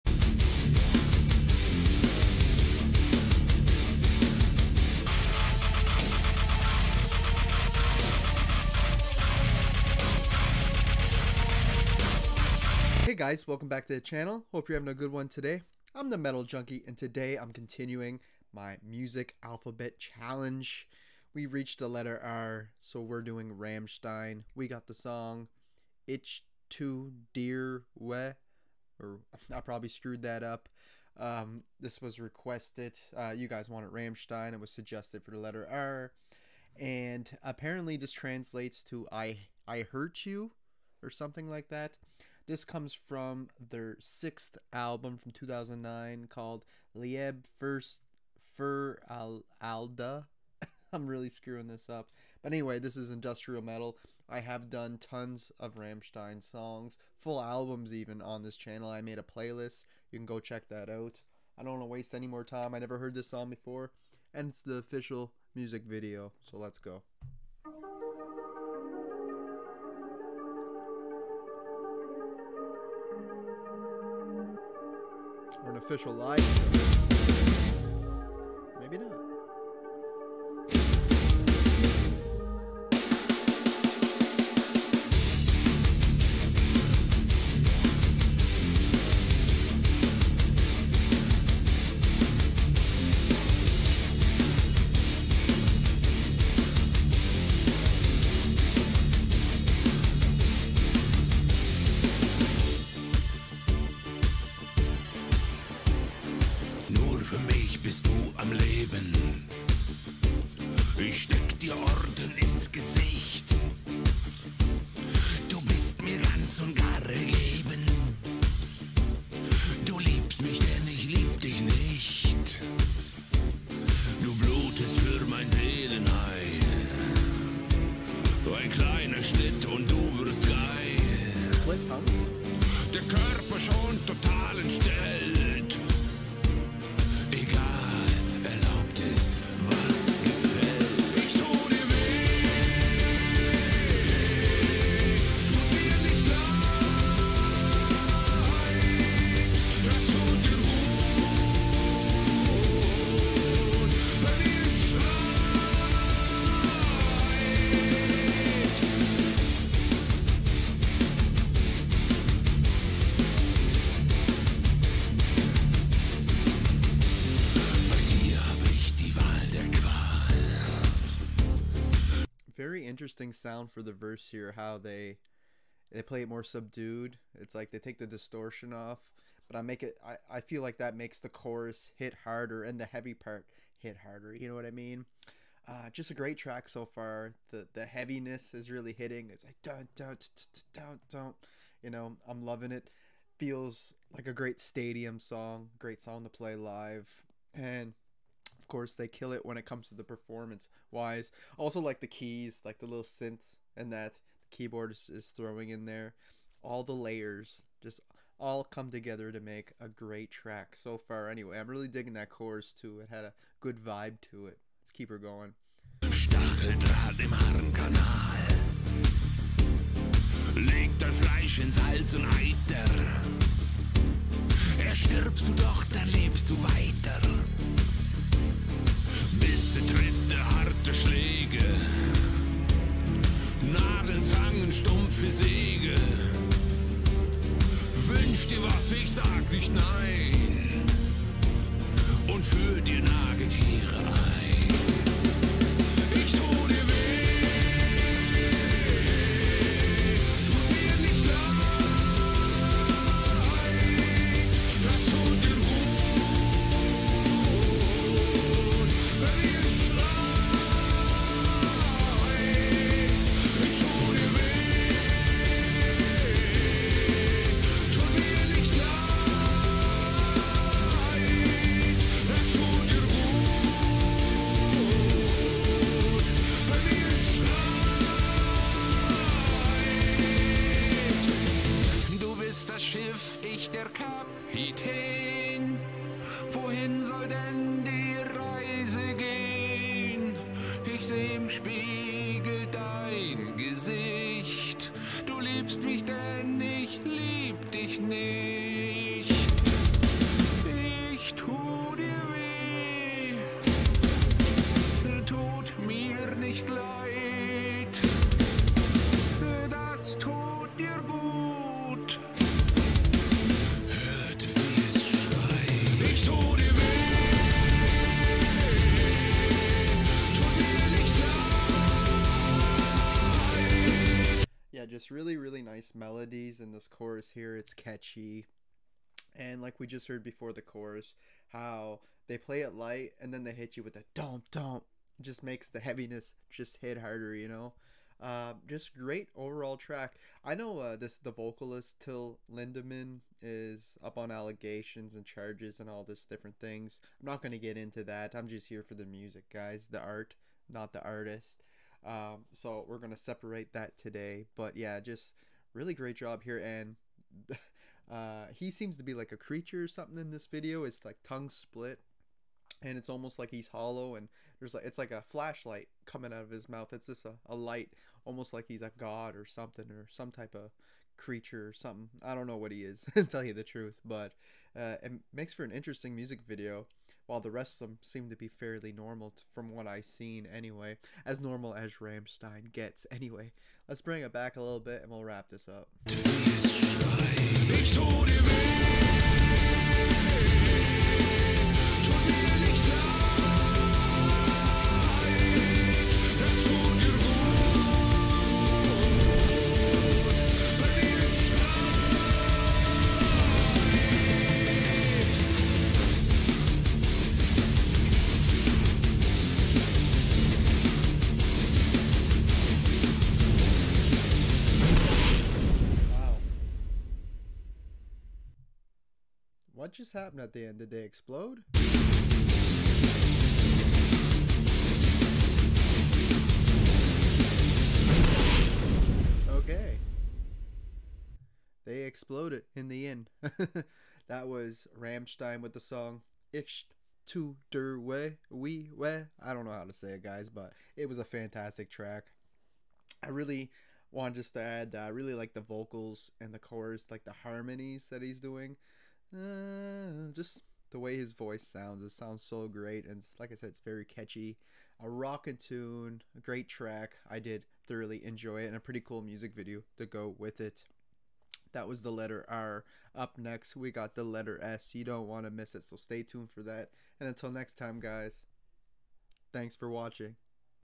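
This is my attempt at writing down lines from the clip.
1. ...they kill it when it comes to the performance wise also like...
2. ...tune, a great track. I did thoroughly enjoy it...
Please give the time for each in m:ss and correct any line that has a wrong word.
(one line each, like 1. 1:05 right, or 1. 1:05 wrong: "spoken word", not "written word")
1. 3:18 right
2. 7:35 right.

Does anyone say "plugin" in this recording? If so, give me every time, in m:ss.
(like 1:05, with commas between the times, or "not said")
not said.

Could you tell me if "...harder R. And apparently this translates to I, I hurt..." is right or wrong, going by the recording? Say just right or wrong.
wrong.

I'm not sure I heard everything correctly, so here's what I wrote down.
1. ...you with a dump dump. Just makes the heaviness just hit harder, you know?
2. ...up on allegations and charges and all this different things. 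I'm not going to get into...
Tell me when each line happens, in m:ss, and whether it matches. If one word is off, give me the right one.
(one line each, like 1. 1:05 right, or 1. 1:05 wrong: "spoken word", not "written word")
1. 5:33 right
2. 5:44 right.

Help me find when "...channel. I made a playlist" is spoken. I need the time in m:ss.
0:58.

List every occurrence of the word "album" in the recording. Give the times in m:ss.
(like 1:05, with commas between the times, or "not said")
0:44, 0:57.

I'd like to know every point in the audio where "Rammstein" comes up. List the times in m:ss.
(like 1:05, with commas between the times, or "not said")
0:23, 0:33, 0:55, 6:22, 7:14.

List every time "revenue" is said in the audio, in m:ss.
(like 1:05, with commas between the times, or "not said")
not said.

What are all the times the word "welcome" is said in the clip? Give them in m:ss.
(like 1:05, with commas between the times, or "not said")
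0:13.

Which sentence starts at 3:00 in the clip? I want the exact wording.
I, I feel like that makes the chorus hit harder and the heavy part hit harder.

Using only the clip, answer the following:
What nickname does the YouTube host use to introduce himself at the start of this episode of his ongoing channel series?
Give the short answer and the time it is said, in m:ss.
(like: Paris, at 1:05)
Metal Junkie, at 0:16.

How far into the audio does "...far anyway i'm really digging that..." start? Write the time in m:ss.
3:30.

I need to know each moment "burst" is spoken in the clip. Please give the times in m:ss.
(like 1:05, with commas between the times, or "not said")
not said.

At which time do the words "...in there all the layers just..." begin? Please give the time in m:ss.
3:25.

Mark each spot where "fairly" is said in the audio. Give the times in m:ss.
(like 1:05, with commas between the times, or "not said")
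6:18.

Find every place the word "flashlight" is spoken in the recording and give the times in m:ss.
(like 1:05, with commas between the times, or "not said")
6:05.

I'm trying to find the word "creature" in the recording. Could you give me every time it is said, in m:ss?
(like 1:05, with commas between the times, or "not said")
5:59, 6:11.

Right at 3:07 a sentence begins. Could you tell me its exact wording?
The the heaviness is really hitting.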